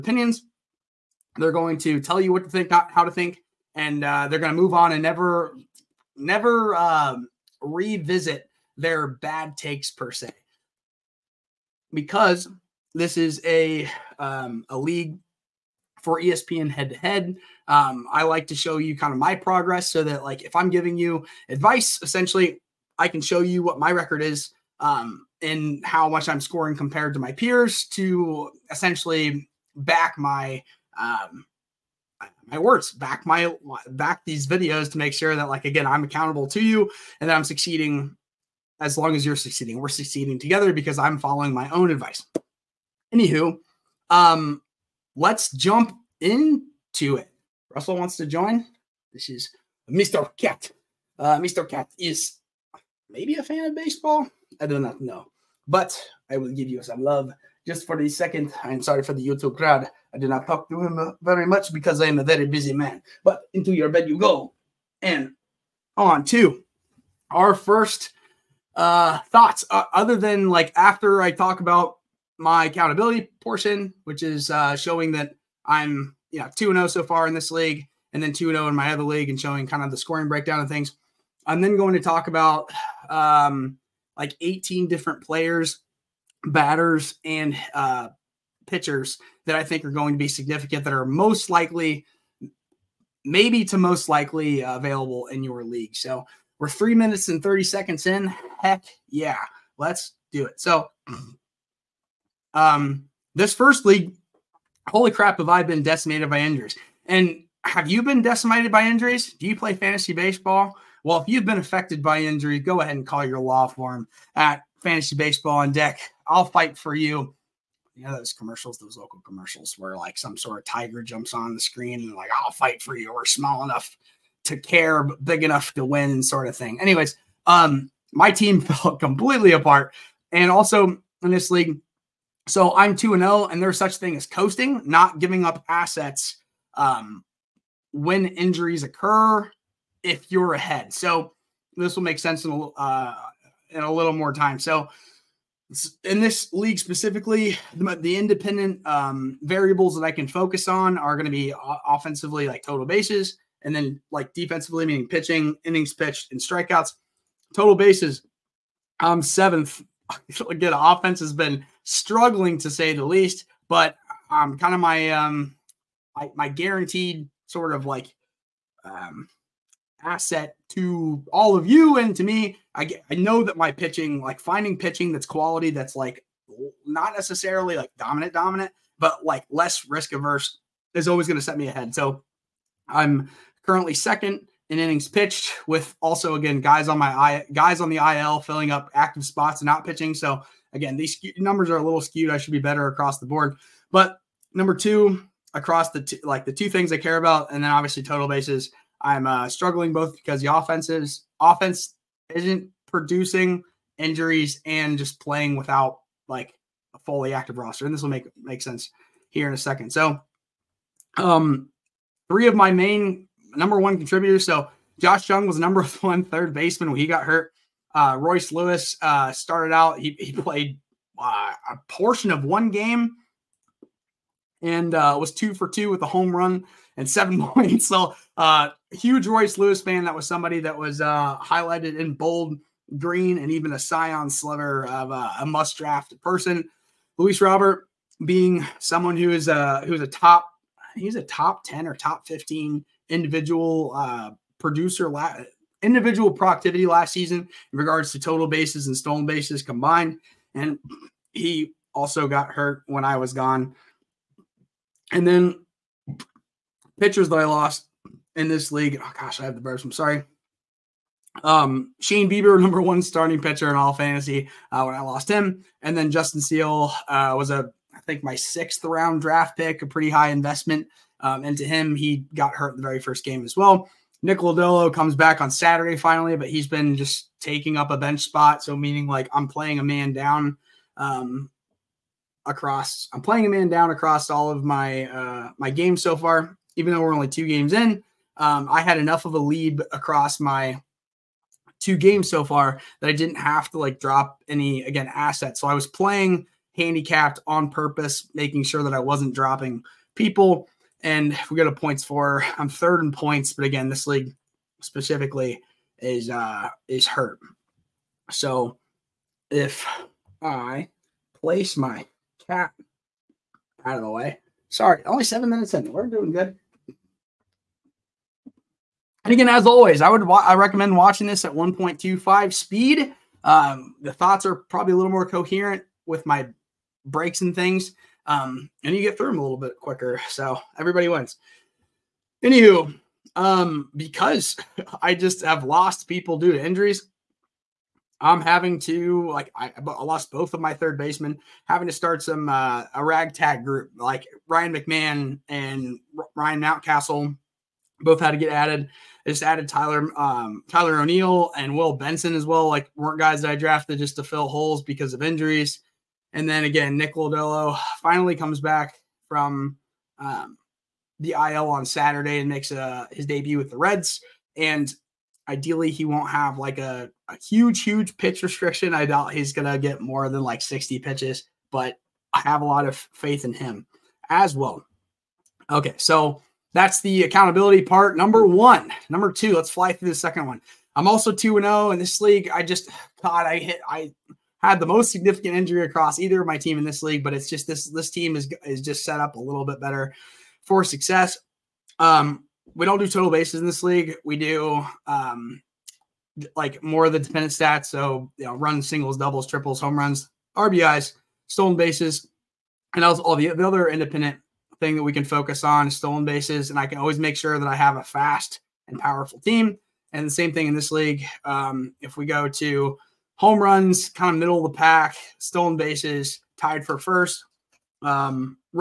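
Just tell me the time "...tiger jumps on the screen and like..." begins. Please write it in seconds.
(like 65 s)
120 s.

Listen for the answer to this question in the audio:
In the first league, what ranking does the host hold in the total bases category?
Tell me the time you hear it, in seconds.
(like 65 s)
159 s.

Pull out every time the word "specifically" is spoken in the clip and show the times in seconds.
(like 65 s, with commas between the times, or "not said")
146 s, 304 s.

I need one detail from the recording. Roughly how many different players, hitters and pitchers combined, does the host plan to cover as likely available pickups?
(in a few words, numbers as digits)
18.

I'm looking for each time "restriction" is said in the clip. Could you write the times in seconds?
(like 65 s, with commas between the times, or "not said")
368 s.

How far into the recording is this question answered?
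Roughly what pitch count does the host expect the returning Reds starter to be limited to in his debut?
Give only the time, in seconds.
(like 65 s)
370 s.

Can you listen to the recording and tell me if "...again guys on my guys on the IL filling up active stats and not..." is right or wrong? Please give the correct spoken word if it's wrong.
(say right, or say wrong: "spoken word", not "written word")
wrong: "spots", not "stats".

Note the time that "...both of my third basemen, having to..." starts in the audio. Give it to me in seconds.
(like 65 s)
340 s.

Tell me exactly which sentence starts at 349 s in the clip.
I just added Tyler um, Tyler O'Neill and Will Benson as well.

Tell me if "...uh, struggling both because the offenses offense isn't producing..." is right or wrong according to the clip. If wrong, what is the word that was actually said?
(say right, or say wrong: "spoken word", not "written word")
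right.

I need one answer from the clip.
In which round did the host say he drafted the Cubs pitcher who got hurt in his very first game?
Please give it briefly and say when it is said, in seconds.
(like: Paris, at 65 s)
Sixth round, at 268 s.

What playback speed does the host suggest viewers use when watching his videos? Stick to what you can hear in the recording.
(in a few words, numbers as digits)
1.25.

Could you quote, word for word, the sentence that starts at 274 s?
Nick Lodolo comes back on Saturday finally, but he's been just taking up a bench spot.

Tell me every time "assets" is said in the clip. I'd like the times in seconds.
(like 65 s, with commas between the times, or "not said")
135 s, 170 s, 295 s.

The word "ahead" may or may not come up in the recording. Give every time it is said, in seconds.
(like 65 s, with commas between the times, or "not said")
112 s, 140 s, 181 s.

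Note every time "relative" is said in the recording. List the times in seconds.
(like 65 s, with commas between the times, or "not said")
not said.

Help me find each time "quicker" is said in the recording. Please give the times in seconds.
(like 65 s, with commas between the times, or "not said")
329 s.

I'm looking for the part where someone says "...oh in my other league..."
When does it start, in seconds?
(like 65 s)
78 s.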